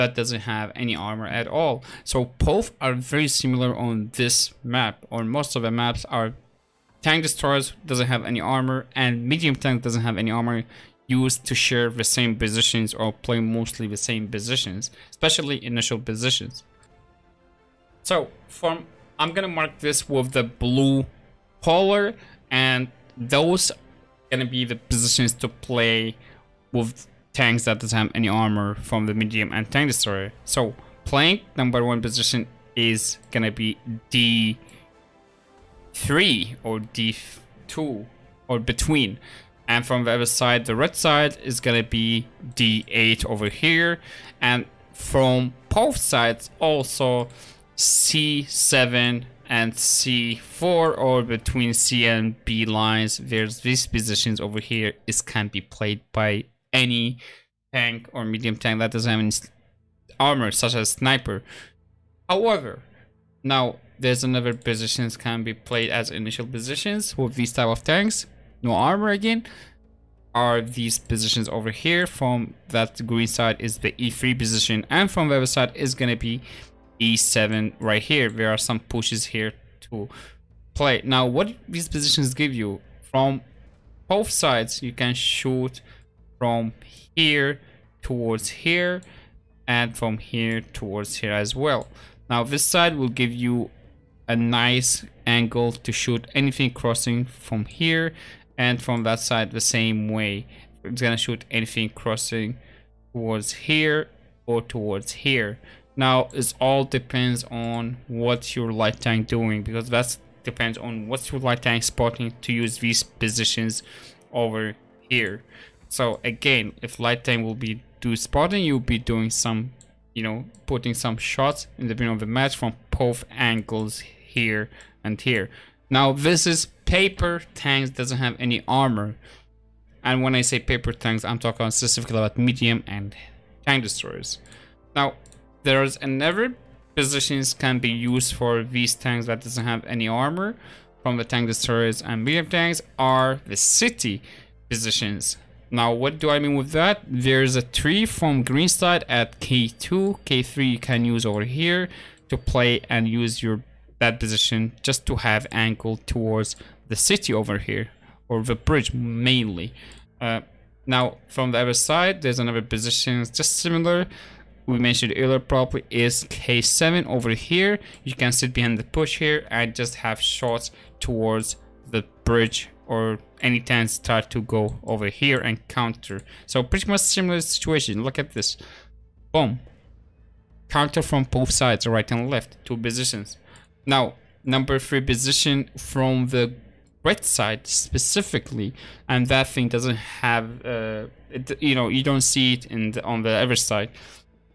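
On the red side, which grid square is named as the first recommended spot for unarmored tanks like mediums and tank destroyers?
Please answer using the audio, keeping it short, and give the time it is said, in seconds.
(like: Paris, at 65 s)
D8, at 42 s.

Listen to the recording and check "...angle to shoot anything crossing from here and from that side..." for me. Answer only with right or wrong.
right.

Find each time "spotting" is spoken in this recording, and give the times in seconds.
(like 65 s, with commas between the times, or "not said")
111 s, 118 s.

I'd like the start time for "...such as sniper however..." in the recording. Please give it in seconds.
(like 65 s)
60 s.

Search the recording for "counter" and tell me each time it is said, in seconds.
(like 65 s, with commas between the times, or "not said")
175 s, 180 s.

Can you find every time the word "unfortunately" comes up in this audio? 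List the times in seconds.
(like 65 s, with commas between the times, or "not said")
not said.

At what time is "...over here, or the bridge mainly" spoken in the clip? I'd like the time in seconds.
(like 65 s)
157 s.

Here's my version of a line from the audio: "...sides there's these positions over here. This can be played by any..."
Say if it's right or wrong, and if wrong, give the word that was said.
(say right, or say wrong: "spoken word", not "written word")
wrong: "lines", not "sides".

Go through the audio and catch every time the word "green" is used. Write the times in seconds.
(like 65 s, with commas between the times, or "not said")
73 s, 148 s.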